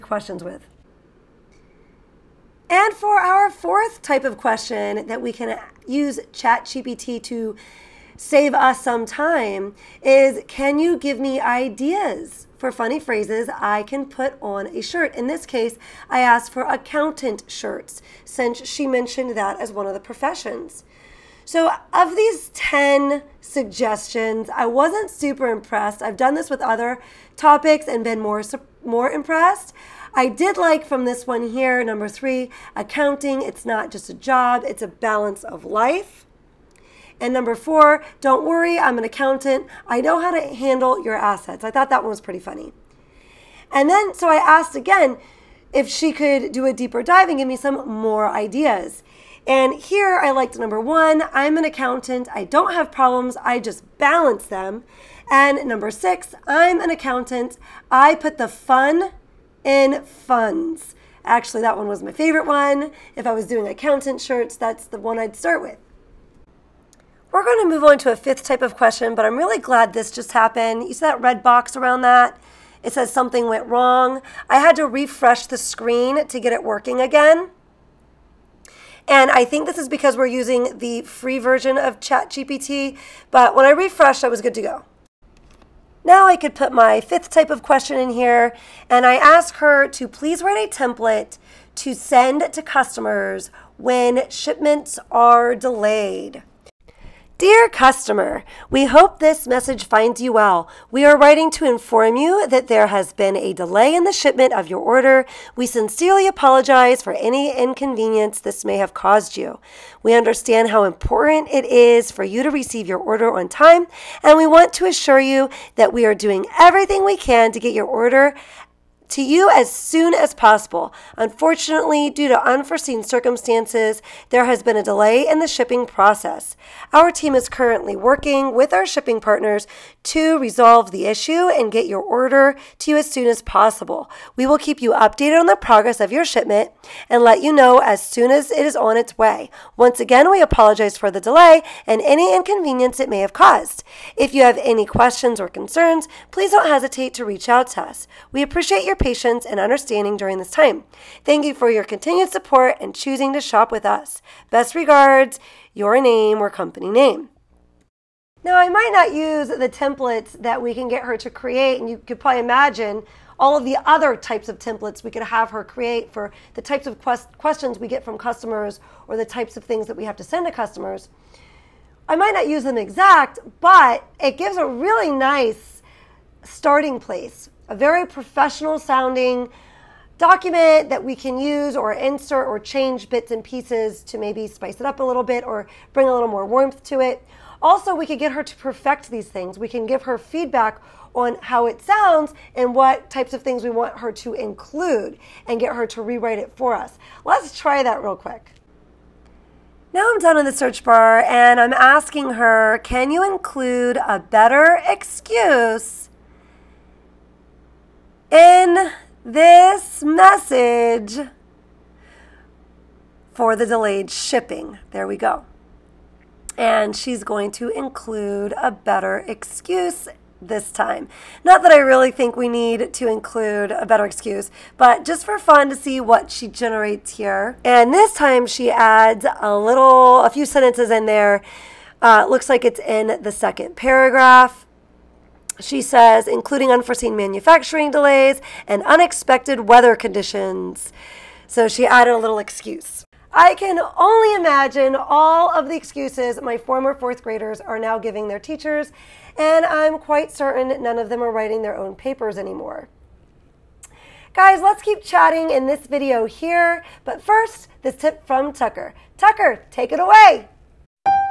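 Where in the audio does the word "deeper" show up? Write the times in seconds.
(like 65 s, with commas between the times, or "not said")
46 s.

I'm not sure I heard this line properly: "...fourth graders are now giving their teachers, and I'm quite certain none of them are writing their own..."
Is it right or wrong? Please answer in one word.
right.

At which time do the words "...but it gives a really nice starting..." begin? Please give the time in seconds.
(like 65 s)
173 s.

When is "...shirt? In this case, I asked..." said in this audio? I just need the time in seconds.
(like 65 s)
14 s.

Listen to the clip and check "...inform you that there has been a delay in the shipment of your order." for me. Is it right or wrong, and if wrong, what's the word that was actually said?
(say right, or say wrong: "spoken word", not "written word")
right.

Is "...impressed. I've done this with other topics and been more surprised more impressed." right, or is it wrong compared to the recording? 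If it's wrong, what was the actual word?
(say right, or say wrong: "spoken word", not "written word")
right.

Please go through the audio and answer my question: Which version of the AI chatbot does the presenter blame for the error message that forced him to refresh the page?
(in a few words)
The free version.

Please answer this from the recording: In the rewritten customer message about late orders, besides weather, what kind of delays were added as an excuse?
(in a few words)
Manufacturing delays.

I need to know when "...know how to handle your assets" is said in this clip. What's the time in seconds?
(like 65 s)
40 s.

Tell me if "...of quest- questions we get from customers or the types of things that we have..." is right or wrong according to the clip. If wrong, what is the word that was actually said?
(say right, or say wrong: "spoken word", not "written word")
right.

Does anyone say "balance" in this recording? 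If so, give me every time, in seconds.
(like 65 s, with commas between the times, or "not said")
34 s, 53 s.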